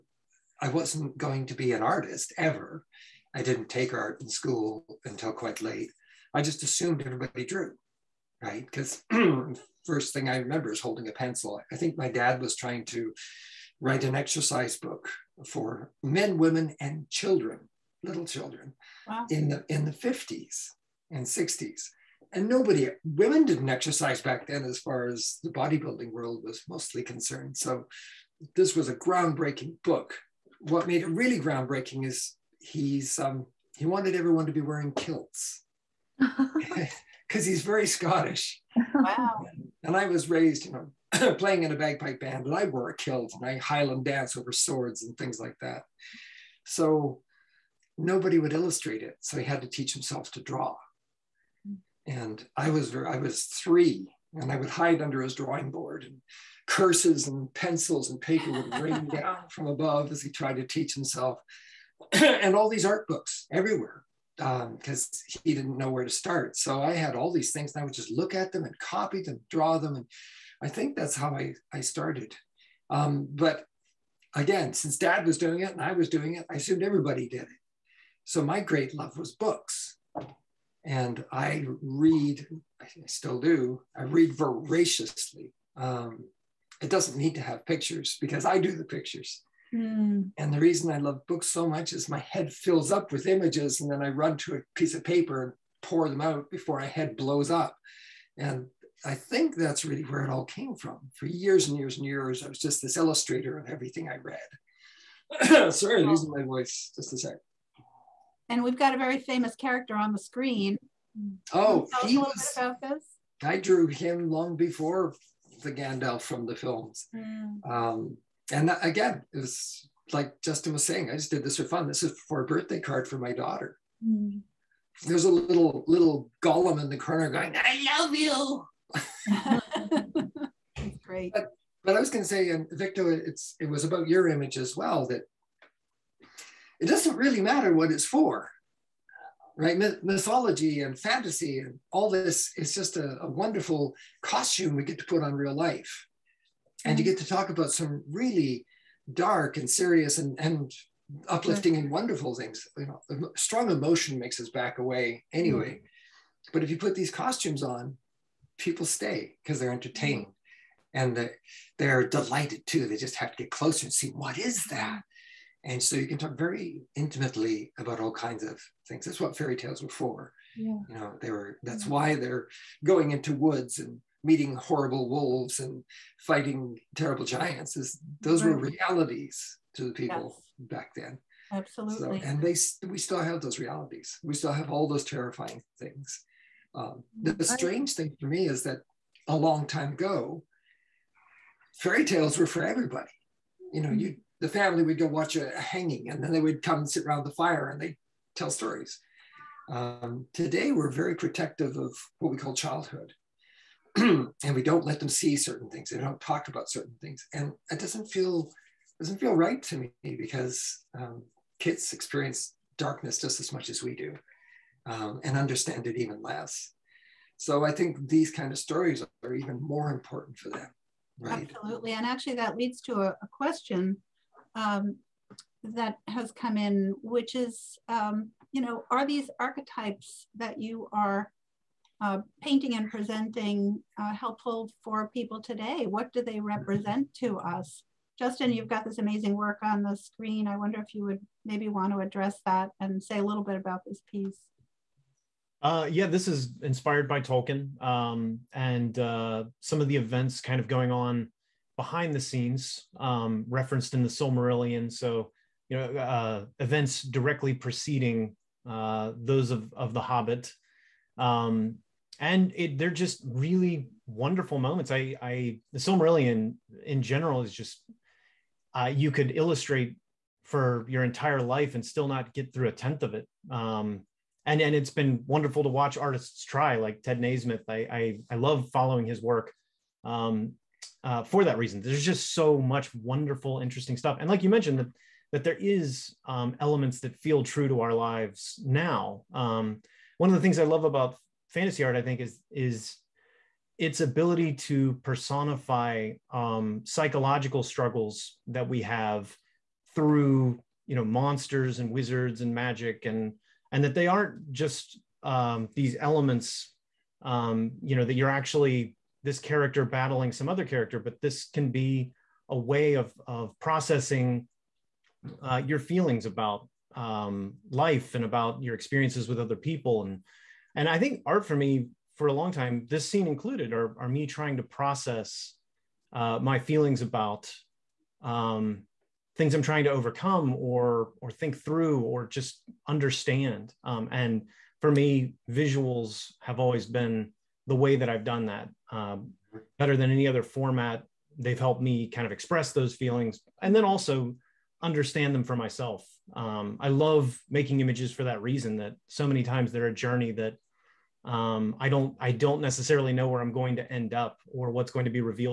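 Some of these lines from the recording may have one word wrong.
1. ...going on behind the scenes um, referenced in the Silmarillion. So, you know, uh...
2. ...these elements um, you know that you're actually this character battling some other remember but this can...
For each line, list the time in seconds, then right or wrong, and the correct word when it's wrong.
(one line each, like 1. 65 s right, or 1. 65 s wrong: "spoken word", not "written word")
1. 250 s right
2. 305 s wrong: "character", not "remember".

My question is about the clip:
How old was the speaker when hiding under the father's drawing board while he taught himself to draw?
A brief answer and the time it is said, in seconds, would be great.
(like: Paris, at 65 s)
3, at 53 s.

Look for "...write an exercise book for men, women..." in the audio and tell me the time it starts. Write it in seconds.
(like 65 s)
13 s.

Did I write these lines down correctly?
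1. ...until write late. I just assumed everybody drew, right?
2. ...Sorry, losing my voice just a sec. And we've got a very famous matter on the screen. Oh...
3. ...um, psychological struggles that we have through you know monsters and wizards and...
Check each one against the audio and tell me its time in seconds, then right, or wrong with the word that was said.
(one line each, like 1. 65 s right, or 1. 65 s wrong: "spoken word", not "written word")
1. 5 s wrong: "quite", not "write"
2. 105 s wrong: "character", not "matter"
3. 296 s right.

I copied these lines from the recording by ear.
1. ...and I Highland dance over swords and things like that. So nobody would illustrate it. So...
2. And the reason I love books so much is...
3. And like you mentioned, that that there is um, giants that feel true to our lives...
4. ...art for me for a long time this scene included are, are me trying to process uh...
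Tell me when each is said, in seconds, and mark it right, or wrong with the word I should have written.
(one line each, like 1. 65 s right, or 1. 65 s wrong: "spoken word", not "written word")
1. 43 s right
2. 90 s right
3. 284 s wrong: "elements", not "giants"
4. 321 s right.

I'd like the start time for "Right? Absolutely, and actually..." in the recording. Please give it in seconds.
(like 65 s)
221 s.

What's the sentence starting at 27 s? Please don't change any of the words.
So this was a groundbreaking book.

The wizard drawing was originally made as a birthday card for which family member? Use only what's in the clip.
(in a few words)
Daughter.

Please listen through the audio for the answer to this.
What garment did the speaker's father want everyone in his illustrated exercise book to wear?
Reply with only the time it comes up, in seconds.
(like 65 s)
34 s.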